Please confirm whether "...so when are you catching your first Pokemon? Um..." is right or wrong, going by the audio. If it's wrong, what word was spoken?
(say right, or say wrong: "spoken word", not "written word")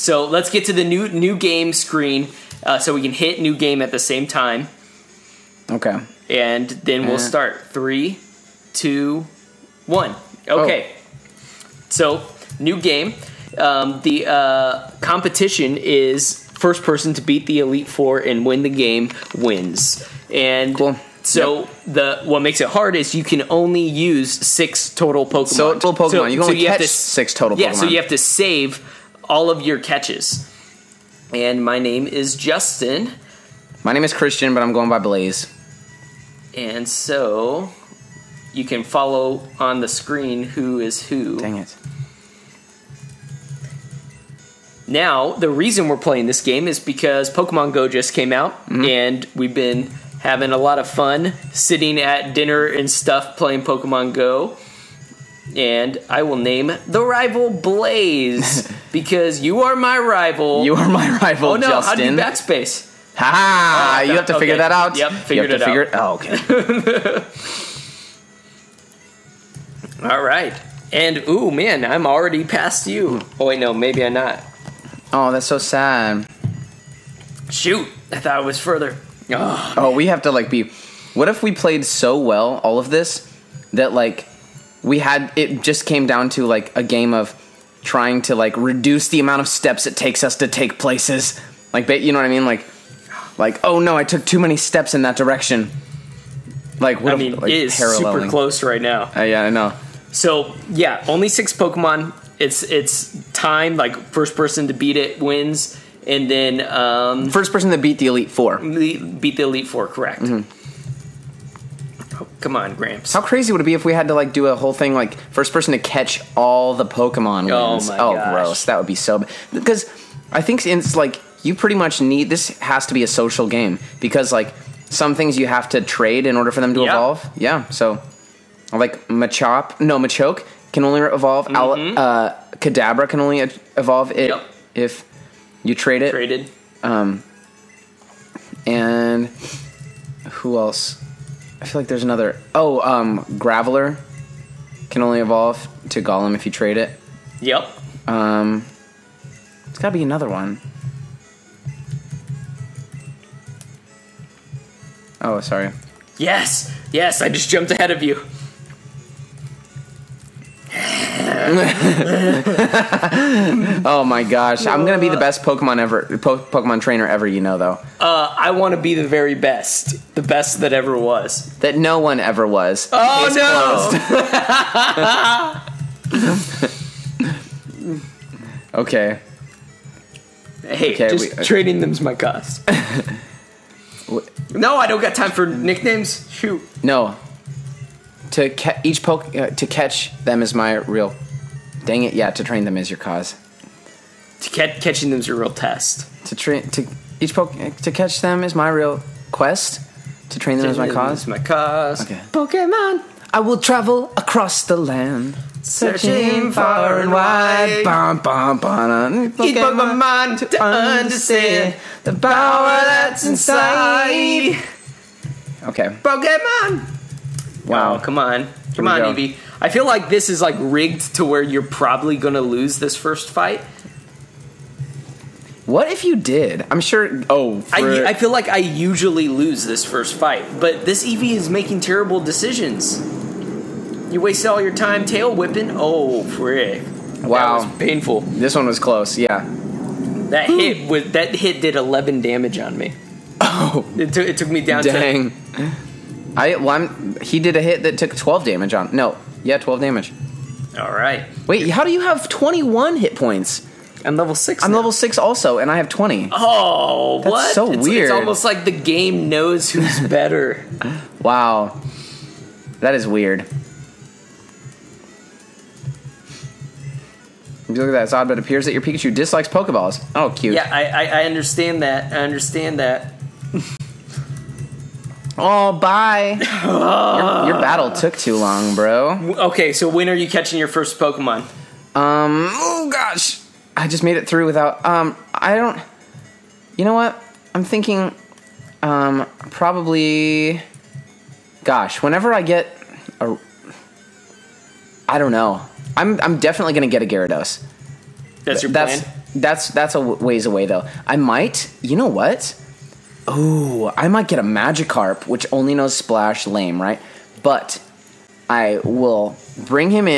right.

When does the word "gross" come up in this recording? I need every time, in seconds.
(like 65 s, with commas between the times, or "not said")
118 s.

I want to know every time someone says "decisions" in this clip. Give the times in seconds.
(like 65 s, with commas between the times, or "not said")
232 s.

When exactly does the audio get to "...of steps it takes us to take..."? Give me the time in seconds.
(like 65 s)
89 s.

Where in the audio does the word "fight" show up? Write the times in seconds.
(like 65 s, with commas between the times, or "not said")
223 s, 230 s.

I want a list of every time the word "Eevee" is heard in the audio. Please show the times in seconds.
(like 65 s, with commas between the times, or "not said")
219 s, 231 s.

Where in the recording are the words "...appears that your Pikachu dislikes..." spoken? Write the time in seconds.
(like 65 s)
268 s.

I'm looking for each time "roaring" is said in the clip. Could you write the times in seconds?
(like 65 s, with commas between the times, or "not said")
not said.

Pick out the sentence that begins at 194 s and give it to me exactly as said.
To catch catching them is your real test.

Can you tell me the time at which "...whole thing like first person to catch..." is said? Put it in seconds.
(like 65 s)
114 s.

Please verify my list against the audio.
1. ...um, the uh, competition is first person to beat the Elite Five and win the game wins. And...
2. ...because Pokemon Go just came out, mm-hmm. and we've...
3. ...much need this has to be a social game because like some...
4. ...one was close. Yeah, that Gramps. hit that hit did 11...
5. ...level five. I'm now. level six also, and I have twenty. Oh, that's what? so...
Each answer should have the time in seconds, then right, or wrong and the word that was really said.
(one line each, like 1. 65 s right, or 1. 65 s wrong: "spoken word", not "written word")
1. 13 s wrong: "Four", not "Five"
2. 46 s right
3. 121 s right
4. 238 s wrong: "Ooh", not "Gramps"
5. 254 s wrong: "six", not "five".